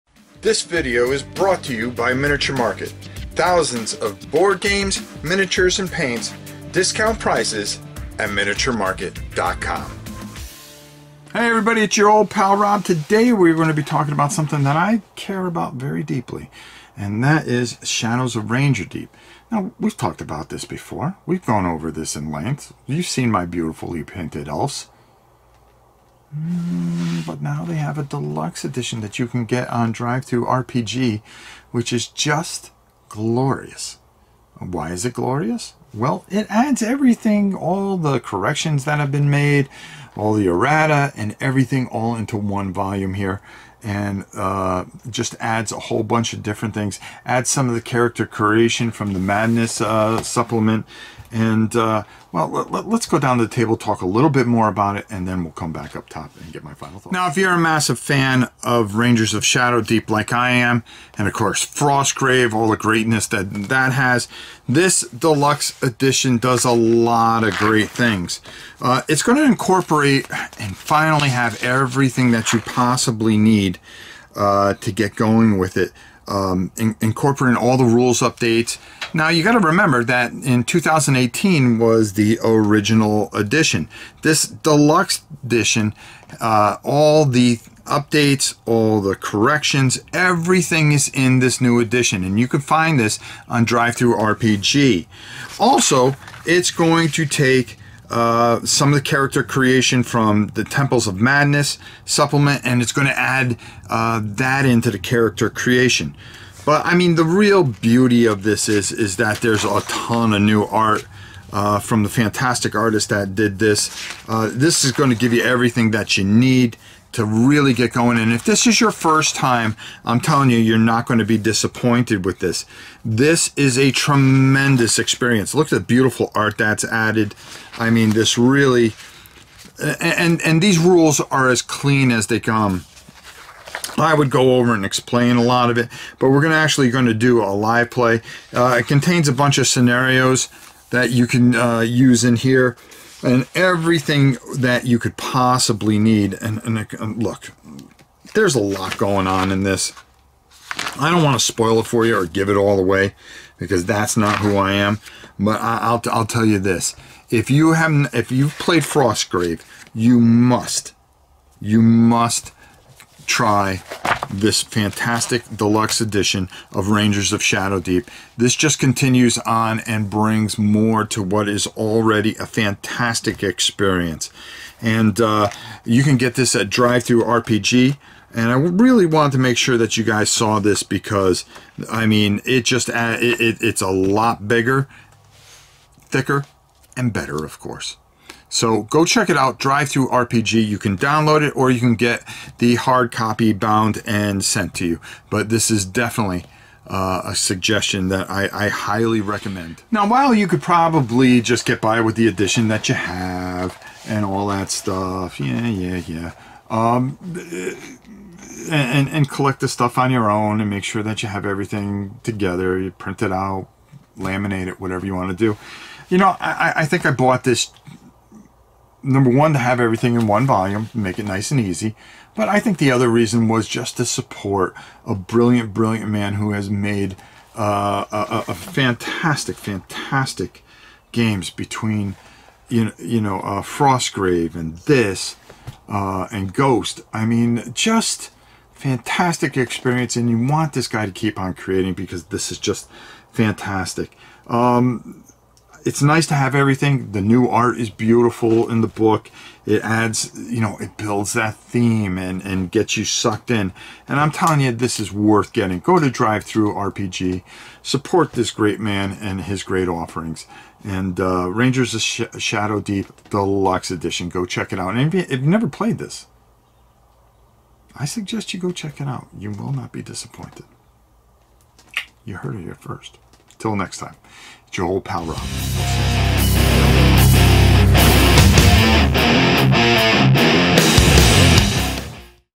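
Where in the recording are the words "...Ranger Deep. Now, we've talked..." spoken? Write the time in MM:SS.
00:18.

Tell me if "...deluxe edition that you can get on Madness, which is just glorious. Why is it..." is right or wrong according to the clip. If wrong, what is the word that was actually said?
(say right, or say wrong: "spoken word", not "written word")
wrong: "DriveThruRPG", not "Madness".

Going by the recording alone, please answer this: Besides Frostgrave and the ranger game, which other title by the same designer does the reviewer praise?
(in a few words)
Ghost.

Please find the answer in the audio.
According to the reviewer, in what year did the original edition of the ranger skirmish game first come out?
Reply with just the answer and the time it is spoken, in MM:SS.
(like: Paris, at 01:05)
2018, at 01:20.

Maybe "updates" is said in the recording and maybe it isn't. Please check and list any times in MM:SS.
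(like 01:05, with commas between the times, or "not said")
01:18, 01:27.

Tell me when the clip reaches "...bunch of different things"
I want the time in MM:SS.
00:46.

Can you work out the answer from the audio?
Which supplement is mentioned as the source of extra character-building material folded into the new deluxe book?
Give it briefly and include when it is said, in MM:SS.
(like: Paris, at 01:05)
Temples of Madness, at 01:40.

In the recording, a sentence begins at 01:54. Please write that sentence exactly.
Uh, this is going to give you everything that you need to really get going.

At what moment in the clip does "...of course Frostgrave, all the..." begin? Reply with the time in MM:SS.
01:01.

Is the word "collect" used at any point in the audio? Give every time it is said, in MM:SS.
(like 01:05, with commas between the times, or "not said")
03:29.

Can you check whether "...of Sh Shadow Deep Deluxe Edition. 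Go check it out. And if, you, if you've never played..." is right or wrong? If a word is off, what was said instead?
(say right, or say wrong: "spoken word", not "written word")
right.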